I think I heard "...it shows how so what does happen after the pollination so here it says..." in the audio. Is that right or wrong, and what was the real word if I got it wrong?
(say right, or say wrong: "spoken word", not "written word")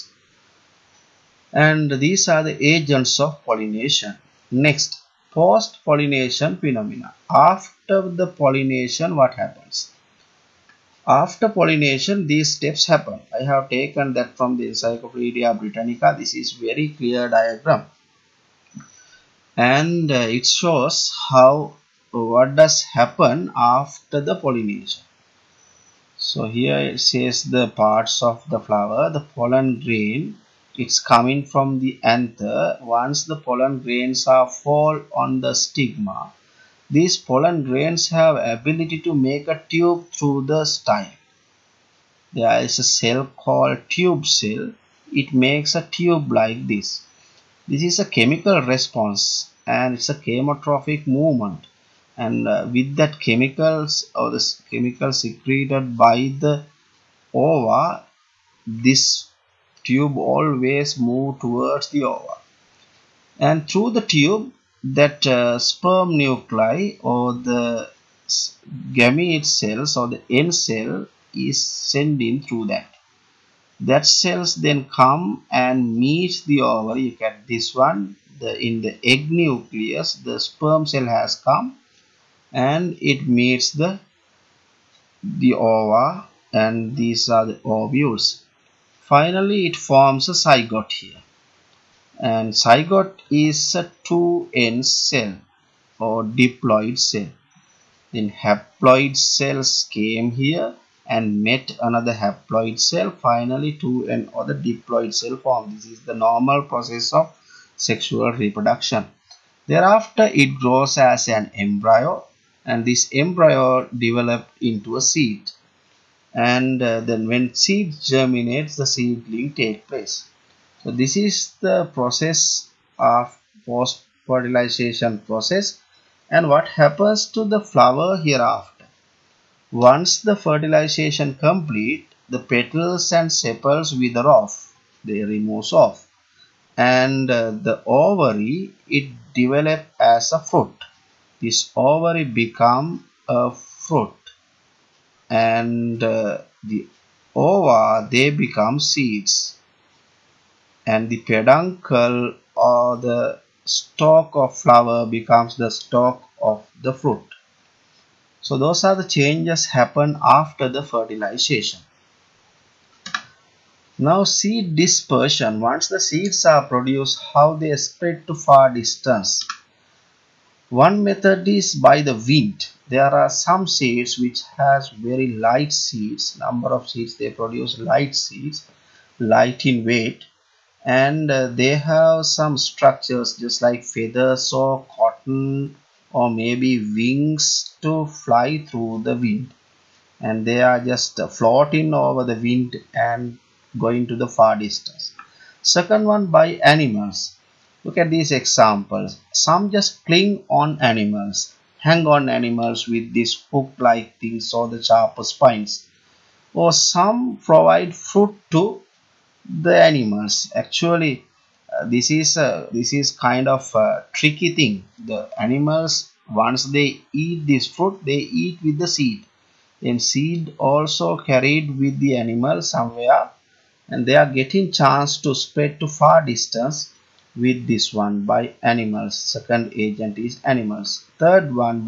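right.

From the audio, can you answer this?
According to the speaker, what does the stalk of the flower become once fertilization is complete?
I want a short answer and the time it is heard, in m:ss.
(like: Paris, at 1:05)
stalk of the fruit, at 2:35.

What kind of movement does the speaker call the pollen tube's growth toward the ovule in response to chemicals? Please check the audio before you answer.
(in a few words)
chemotropic movement.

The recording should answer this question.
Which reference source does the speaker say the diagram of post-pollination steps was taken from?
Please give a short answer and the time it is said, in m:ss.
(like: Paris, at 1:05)
Encyclopedia Britannica, at 0:14.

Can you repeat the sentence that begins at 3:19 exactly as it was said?
Some just cling on animals, hang on animals with these hook-like things or the sharp spines.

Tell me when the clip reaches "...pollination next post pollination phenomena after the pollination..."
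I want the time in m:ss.
0:03.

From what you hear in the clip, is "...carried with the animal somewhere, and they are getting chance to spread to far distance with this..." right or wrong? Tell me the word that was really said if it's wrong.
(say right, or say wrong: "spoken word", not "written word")
right.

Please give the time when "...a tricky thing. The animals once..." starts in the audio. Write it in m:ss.
3:33.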